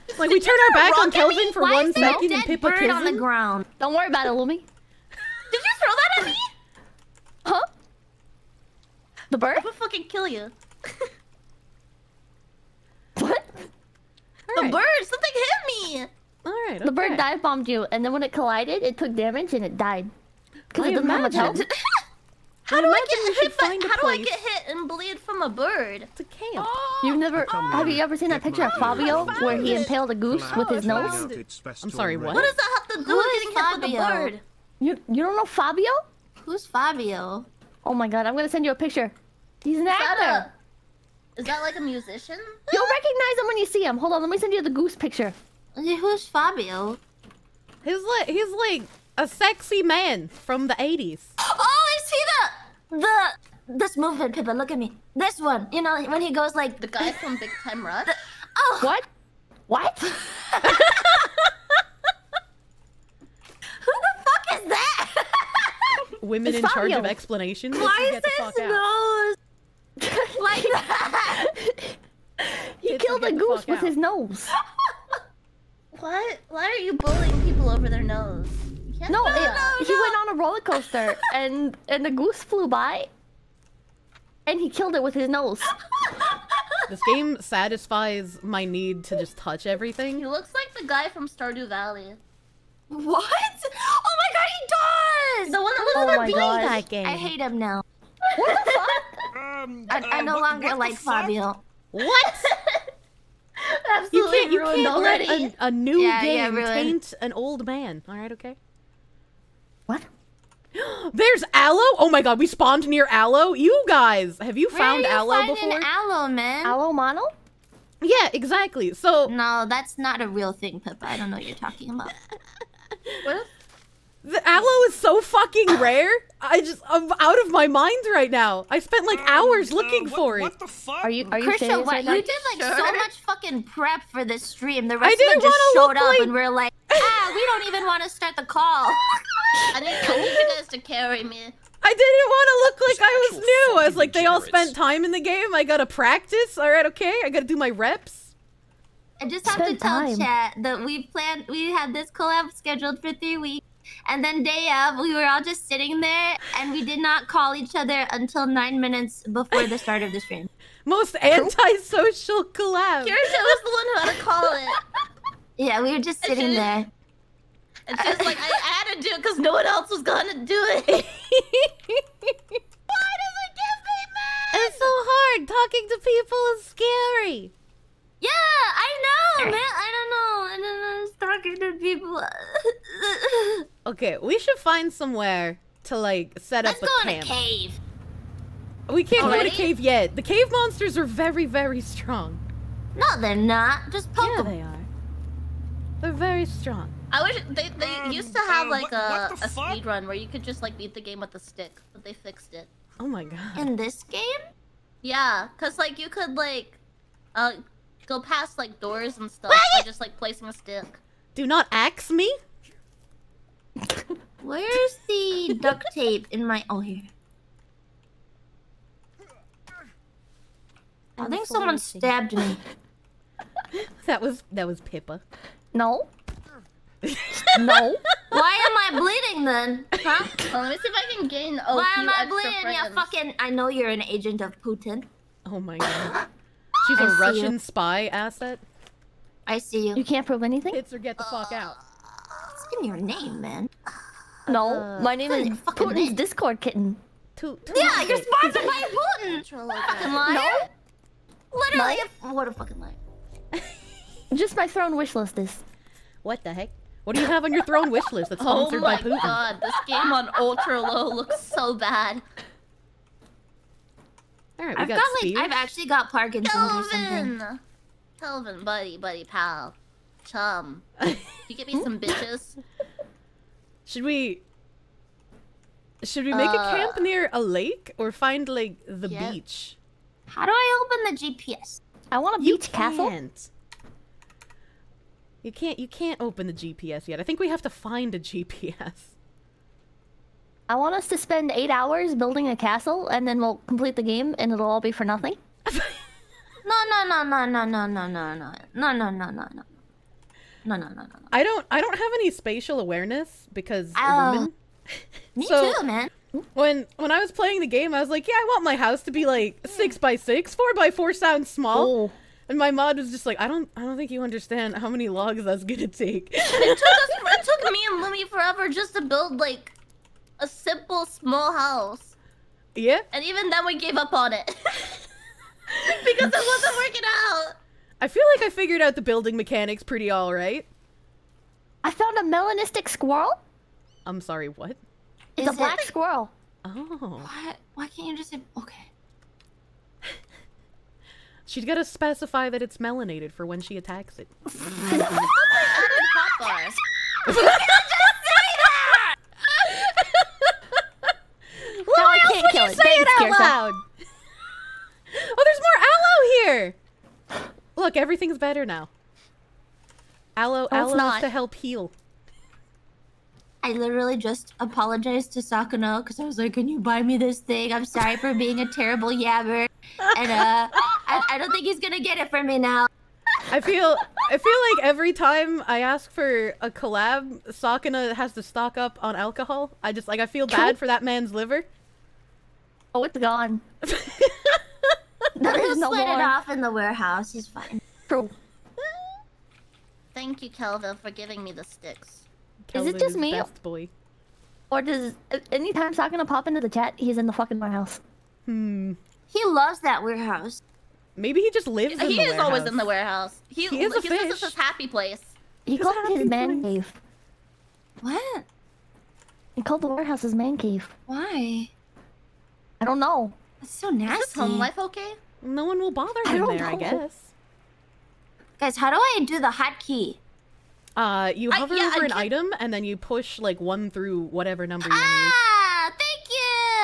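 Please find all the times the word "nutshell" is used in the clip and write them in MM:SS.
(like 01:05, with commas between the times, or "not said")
not said.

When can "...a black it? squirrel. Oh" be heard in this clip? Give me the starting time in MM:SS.
05:35.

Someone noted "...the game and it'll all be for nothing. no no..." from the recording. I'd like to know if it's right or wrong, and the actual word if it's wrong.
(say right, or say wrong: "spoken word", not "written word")
right.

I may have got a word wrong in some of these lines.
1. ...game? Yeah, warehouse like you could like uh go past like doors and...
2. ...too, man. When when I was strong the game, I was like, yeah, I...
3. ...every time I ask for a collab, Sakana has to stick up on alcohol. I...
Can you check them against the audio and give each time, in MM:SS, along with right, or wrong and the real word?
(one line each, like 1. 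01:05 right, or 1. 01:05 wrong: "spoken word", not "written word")
1. 03:24 wrong: "cause", not "warehouse"
2. 05:05 wrong: "playing", not "strong"
3. 06:14 wrong: "stock", not "stick".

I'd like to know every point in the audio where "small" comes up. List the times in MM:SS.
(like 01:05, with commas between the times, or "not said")
05:11, 05:21.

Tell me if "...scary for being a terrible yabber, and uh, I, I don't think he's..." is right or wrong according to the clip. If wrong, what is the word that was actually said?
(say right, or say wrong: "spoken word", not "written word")
wrong: "sorry", not "scary".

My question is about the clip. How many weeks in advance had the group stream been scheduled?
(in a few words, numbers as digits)
3 weeks.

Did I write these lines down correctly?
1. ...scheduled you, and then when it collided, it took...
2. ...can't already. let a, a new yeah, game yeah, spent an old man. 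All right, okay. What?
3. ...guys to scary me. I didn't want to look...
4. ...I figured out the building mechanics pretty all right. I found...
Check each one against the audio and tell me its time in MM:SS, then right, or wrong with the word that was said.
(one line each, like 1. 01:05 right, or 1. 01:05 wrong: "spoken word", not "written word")
1. 00:17 wrong: "bombed", not "scheduled"
2. 01:44 wrong: "taint", not "spent"
3. 02:20 wrong: "carry", not "scary"
4. 05:28 right.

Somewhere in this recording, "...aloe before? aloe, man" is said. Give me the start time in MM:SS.
01:55.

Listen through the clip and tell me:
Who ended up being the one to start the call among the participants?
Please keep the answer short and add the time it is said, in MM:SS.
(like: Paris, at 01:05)
Kirsche, at 02:43.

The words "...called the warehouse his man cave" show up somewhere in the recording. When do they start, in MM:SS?
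06:49.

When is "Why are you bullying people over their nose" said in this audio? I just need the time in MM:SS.
01:16.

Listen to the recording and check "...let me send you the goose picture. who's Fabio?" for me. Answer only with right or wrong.
right.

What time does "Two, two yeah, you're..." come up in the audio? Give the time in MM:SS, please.
04:07.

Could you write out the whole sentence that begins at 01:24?
And he killed it with his nose.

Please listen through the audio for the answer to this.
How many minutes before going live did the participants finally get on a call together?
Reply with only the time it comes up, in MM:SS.
02:38.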